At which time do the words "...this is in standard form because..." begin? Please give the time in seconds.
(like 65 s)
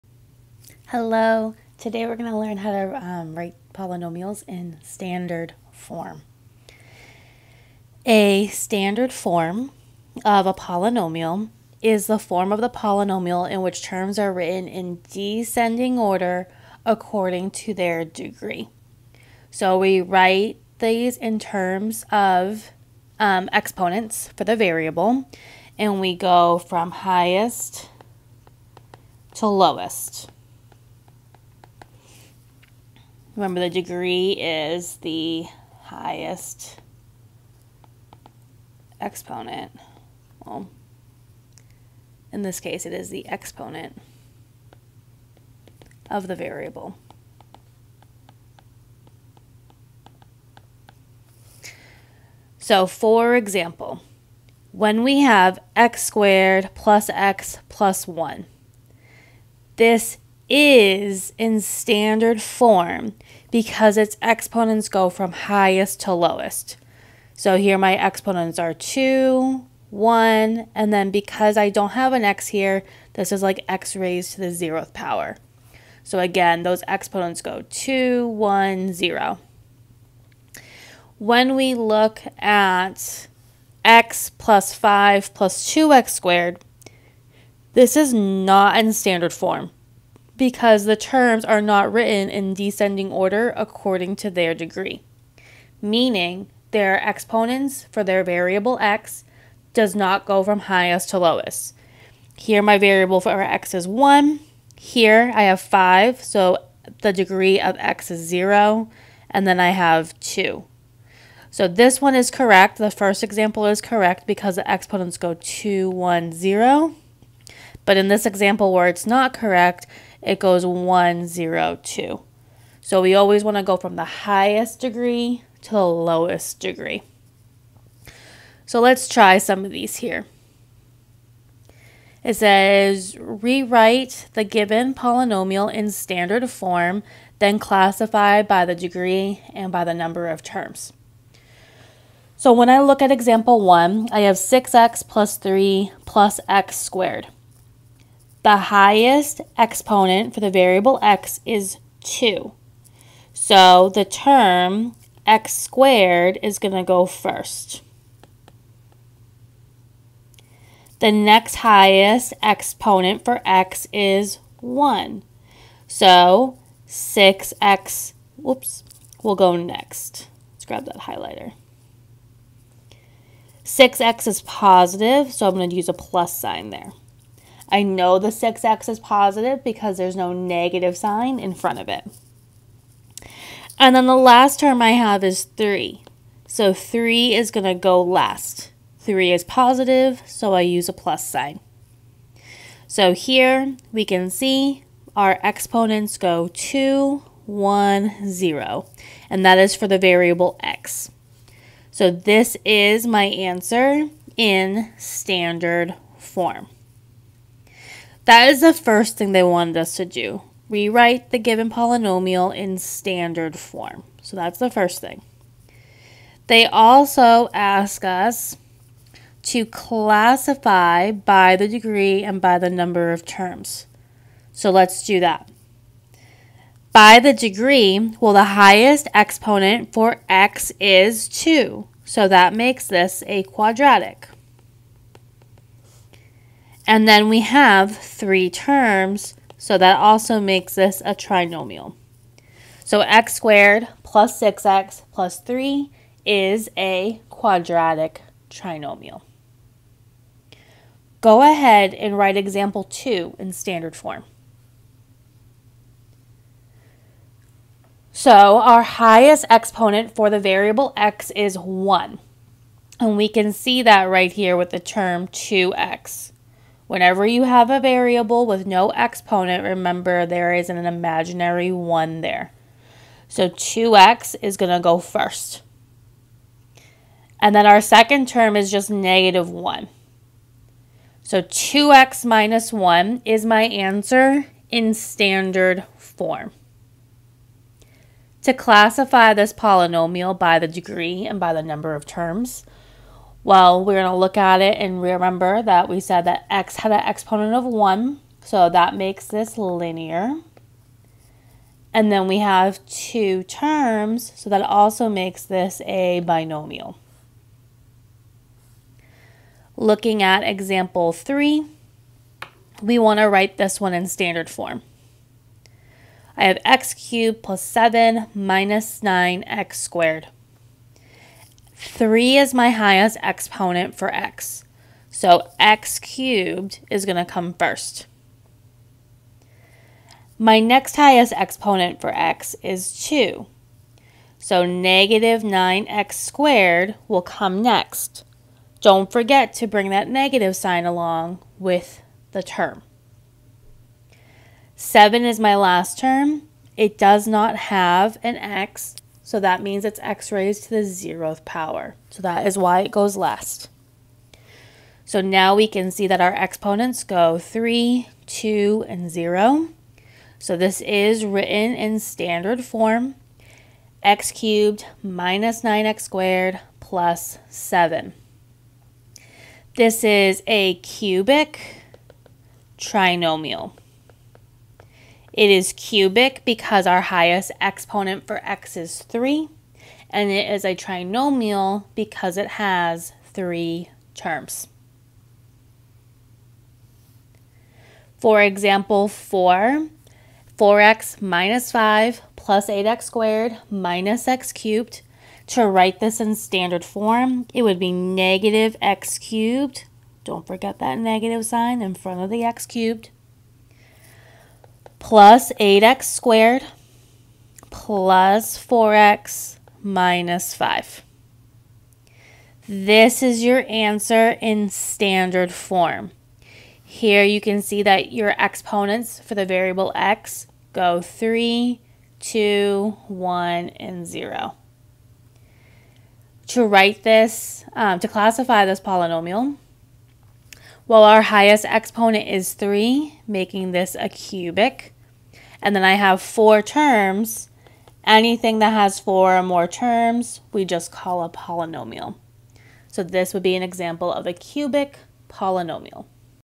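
59 s.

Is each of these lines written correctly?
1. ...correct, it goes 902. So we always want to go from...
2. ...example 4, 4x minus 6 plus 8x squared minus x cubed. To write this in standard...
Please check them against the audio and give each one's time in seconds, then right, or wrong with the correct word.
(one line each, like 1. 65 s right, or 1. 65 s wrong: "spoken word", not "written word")
1. 119 s wrong: "102", not "902"
2. 388 s wrong: "5", not "6".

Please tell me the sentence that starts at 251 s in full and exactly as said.
Go ahead and write example 2 in standard form.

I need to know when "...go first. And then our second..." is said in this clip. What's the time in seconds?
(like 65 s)
274 s.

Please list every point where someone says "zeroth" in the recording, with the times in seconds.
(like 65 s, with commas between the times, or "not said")
74 s, 350 s.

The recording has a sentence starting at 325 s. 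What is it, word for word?
So x cubed is going to come first.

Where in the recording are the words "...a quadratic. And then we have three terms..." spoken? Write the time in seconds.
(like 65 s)
233 s.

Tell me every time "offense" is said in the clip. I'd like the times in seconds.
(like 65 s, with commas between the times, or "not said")
not said.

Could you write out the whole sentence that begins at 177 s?
I know the 6x is positive because there's no negative sign in front of it.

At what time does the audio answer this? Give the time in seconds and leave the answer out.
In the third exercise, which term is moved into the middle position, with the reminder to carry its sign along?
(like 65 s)
334 s.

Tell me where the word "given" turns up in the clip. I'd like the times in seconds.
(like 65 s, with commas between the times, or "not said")
134 s, 211 s.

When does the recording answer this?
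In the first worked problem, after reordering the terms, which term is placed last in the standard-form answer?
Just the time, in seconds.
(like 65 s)
186 s.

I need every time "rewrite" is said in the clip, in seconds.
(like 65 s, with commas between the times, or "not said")
133 s, 210 s.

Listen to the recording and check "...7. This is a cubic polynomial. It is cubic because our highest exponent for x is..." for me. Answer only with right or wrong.
wrong.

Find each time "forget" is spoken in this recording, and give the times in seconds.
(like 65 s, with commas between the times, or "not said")
339 s, 400 s.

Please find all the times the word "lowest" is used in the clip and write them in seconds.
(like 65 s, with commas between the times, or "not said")
29 s, 66 s, 101 s, 125 s.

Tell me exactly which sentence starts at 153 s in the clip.
So the term x squared is going to go first.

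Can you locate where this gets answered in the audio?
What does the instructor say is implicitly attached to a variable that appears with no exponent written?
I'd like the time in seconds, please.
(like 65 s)
270 s.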